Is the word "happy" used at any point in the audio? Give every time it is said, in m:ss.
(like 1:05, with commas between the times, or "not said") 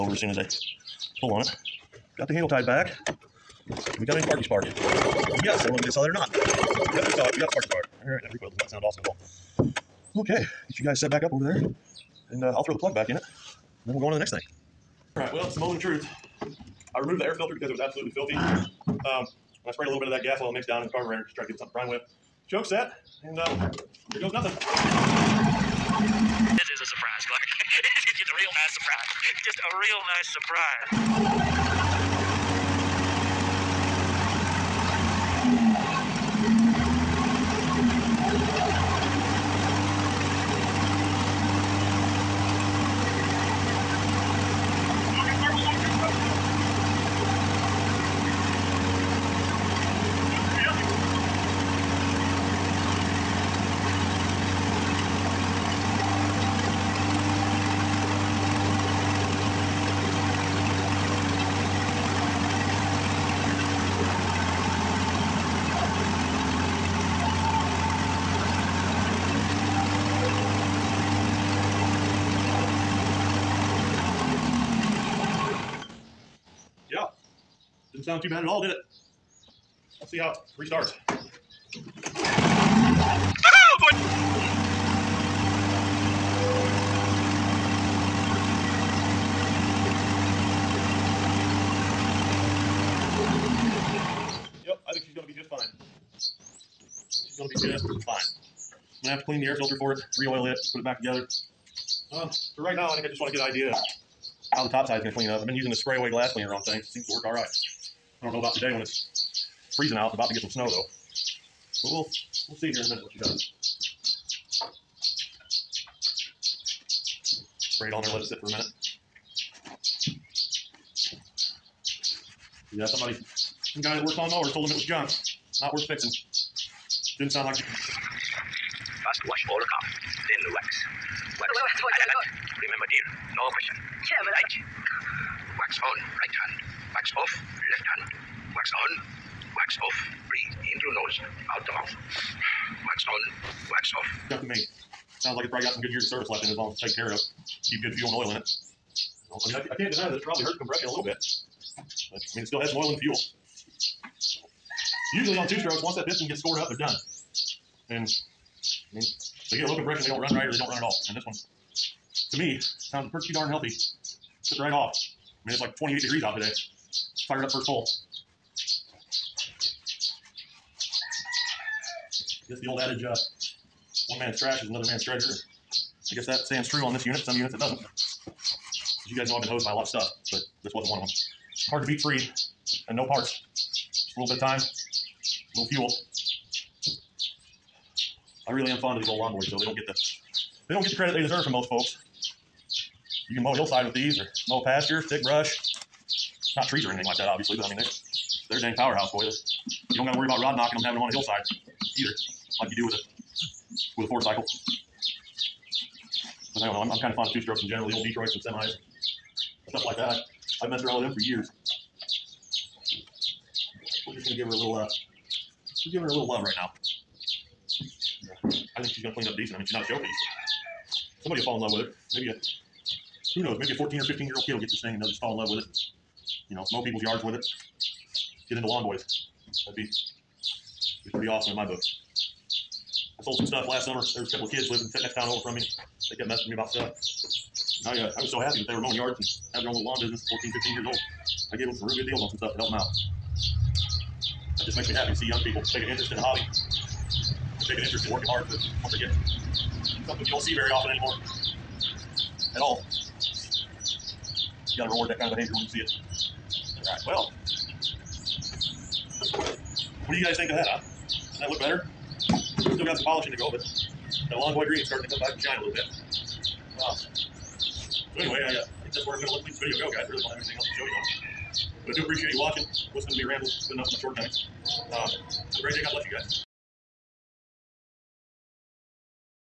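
3:58, 4:04.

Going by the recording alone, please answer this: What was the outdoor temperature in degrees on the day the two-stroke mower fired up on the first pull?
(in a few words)
28.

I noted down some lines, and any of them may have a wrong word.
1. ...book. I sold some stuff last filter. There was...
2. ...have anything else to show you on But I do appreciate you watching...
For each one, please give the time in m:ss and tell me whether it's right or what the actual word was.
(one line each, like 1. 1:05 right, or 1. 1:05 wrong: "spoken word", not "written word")
1. 3:51 wrong: "summer", not "filter"
2. 4:30 right.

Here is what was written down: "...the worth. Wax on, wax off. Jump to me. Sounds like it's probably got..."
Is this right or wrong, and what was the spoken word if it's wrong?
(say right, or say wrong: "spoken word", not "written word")
wrong: "mouth", not "worth".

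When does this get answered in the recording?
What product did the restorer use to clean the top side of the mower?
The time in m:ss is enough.
1:45.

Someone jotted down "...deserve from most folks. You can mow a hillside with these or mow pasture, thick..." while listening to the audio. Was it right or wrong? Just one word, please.
right.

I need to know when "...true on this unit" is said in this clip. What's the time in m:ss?
2:56.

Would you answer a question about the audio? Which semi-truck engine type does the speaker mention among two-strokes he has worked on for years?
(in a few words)
Detroits.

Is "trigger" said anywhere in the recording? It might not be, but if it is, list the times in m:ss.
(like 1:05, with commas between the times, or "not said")
not said.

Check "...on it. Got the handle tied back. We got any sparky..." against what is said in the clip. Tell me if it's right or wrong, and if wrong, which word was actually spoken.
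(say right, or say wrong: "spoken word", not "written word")
right.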